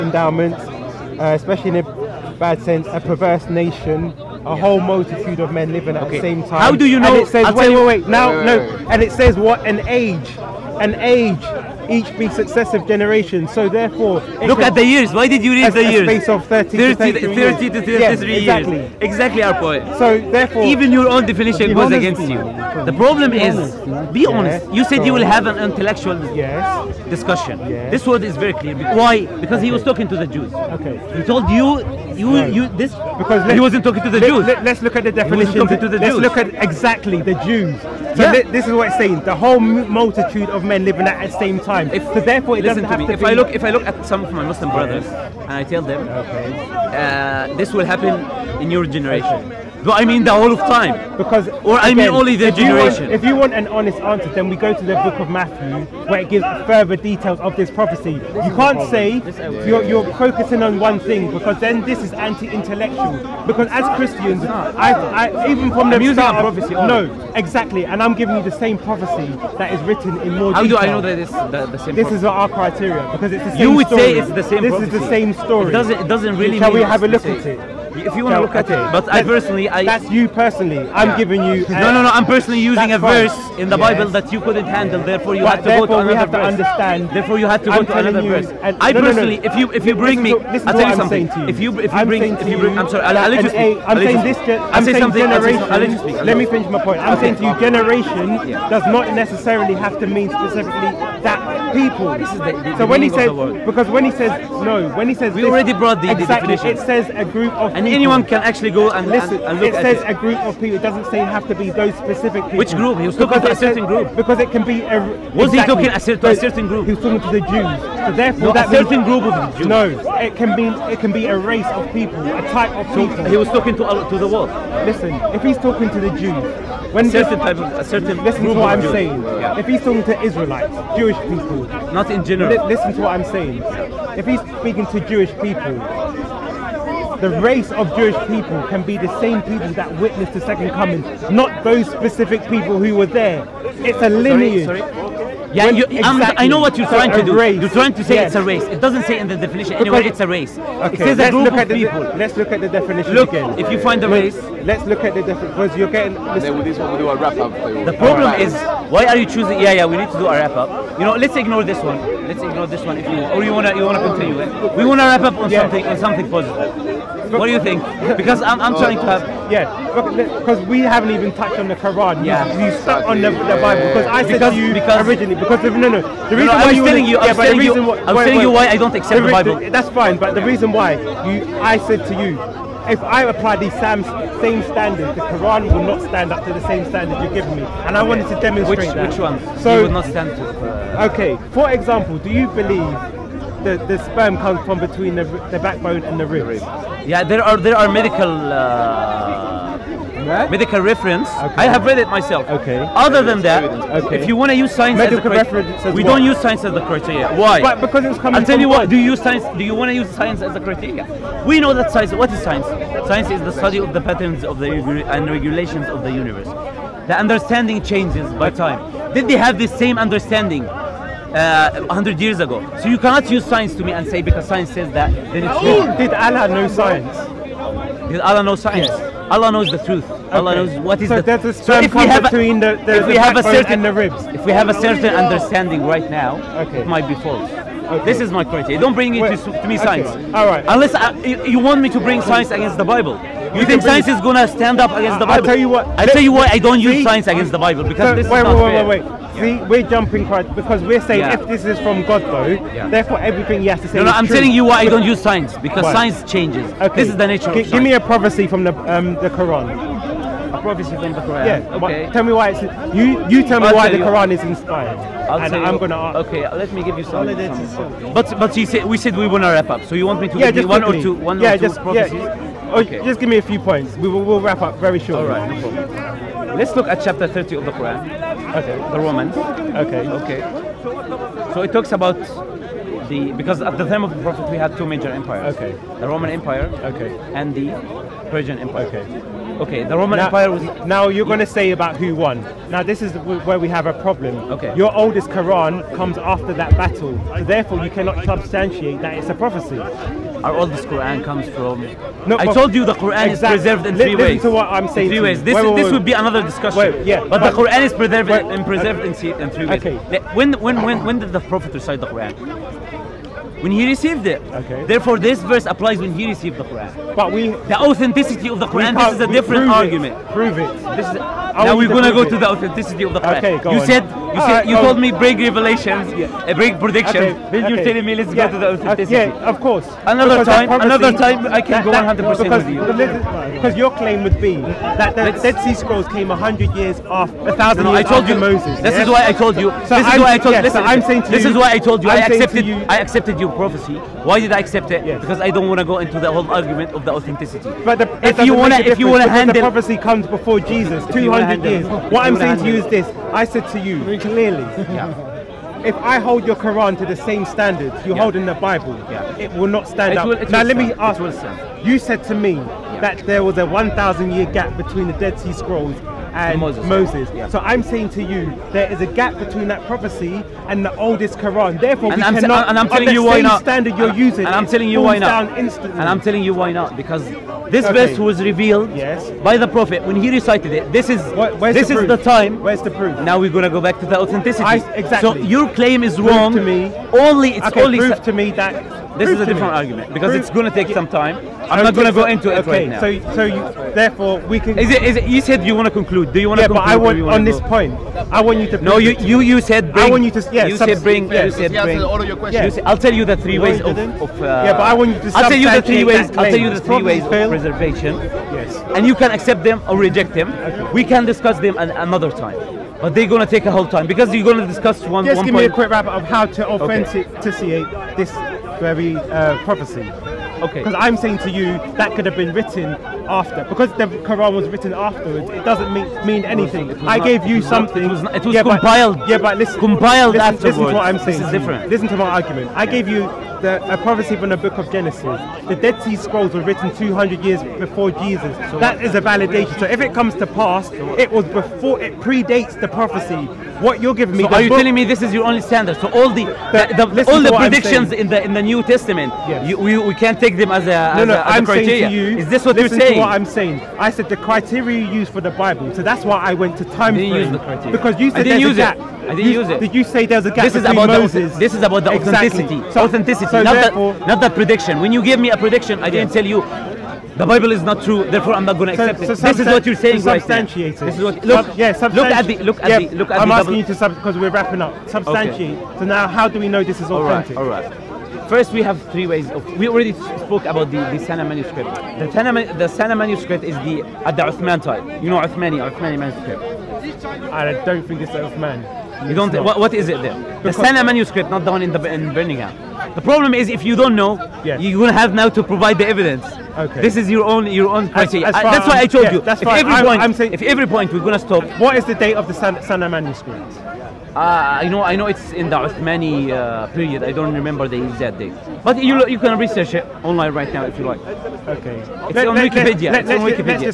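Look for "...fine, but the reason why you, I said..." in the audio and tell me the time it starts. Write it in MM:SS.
02:59.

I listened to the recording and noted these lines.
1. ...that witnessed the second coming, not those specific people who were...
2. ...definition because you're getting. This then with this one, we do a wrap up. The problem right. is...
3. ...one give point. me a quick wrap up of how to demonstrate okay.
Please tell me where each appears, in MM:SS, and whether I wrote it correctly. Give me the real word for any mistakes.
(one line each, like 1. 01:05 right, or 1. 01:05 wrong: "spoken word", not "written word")
1. 02:19 right
2. 02:35 right
3. 06:55 wrong: "authenticate", not "demonstrate".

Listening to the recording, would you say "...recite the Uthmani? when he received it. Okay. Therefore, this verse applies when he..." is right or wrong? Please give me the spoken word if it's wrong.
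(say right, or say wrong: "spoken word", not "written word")
wrong: "Quran", not "Uthmani".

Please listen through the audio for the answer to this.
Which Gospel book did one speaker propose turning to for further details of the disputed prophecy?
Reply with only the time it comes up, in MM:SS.
00:55.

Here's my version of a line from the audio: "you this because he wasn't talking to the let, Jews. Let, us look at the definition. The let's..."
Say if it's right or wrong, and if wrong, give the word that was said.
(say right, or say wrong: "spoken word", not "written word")
right.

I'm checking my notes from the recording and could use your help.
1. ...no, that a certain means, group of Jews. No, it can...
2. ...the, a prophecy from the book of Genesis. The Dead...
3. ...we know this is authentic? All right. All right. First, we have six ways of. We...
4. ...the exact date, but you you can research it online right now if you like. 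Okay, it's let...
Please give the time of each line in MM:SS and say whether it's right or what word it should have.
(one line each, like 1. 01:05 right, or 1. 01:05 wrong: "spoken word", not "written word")
1. 01:58 right
2. 07:13 right
3. 07:56 wrong: "three", not "six"
4. 08:27 right.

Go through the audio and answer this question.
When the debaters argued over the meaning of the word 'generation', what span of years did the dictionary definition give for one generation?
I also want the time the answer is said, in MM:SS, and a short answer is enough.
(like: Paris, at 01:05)
30 to 33 years, at 00:17.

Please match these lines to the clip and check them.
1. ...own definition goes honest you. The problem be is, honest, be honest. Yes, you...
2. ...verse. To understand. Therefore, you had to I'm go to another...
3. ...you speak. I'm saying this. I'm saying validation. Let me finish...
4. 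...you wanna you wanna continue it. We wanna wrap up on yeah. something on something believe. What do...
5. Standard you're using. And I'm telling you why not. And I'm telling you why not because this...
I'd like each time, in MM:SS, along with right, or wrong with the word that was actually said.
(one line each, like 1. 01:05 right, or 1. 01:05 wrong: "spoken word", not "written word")
1. 00:21 wrong: "against", not "honest"
2. 01:26 right
3. 01:33 wrong: "generation", not "validation"
4. 02:43 wrong: "positive", not "believe"
5. 06:13 right.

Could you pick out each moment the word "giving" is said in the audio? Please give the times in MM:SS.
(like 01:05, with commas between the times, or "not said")
01:08, 01:21, 07:24.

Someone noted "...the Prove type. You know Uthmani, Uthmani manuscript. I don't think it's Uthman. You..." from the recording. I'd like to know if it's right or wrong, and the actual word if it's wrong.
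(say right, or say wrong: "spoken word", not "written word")
wrong: "Uthman", not "Prove".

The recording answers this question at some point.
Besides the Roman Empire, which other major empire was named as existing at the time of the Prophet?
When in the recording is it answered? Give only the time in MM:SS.
04:48.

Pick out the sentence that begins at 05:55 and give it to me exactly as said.
if I hold your Quran to the same standards you're yeah.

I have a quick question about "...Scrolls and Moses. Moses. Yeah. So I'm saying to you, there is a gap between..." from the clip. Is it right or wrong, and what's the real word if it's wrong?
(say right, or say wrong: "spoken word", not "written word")
right.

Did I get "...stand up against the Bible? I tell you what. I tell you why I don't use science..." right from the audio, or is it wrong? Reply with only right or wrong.
right.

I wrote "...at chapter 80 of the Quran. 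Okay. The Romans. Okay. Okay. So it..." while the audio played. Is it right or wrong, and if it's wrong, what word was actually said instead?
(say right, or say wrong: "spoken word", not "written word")
wrong: "30", not "80".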